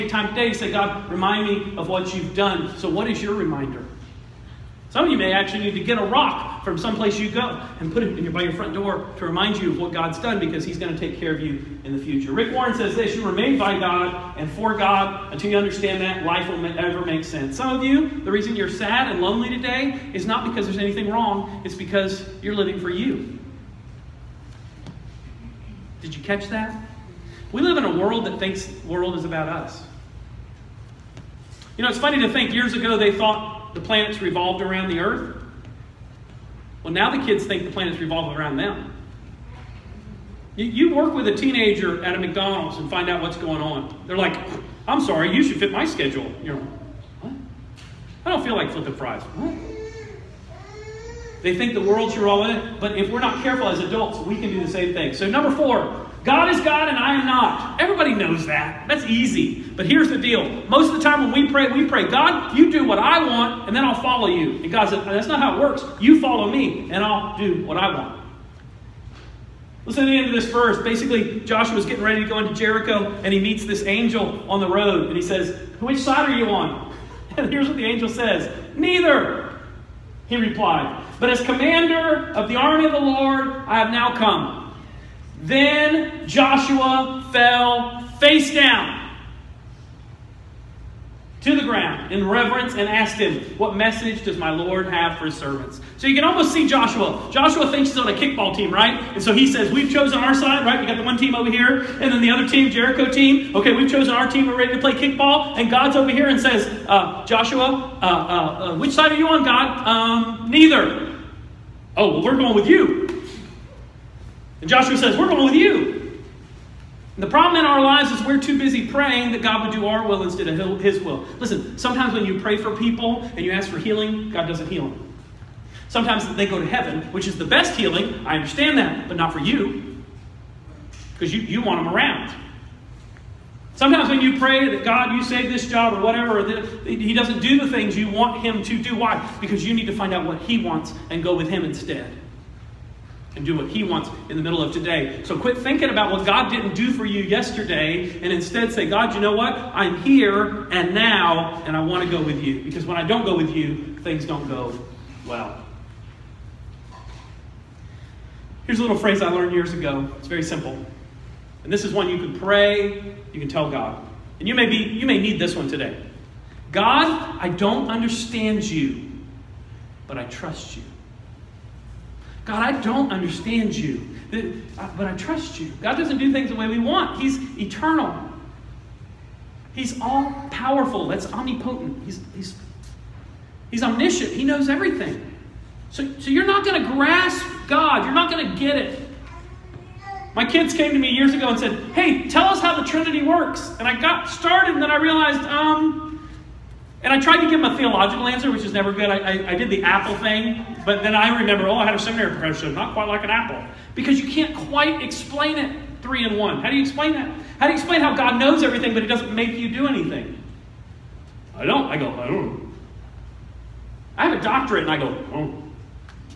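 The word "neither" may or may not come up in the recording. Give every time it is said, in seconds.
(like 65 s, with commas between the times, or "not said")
78 s, 110 s.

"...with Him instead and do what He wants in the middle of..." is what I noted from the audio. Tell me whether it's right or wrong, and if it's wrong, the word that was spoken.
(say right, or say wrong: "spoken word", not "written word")
right.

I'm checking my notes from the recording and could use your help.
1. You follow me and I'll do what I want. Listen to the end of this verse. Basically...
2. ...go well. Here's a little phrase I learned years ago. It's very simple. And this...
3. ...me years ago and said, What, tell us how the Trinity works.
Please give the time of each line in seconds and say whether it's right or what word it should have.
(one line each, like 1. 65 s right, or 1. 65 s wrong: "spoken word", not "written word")
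1. 65 s right
2. 154 s right
3. 190 s wrong: "Hey", not "What".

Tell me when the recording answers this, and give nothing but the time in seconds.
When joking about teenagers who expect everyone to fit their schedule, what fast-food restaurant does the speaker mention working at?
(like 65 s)
42 s.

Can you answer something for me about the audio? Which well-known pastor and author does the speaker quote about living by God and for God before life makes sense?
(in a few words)
Rick Warren.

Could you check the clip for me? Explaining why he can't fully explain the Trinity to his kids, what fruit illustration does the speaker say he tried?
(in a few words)
the apple.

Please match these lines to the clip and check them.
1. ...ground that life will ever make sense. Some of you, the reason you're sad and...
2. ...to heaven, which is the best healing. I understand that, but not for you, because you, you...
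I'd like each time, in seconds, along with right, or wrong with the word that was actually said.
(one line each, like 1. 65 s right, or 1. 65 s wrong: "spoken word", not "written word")
1. 15 s wrong: "understand", not "ground"
2. 126 s right.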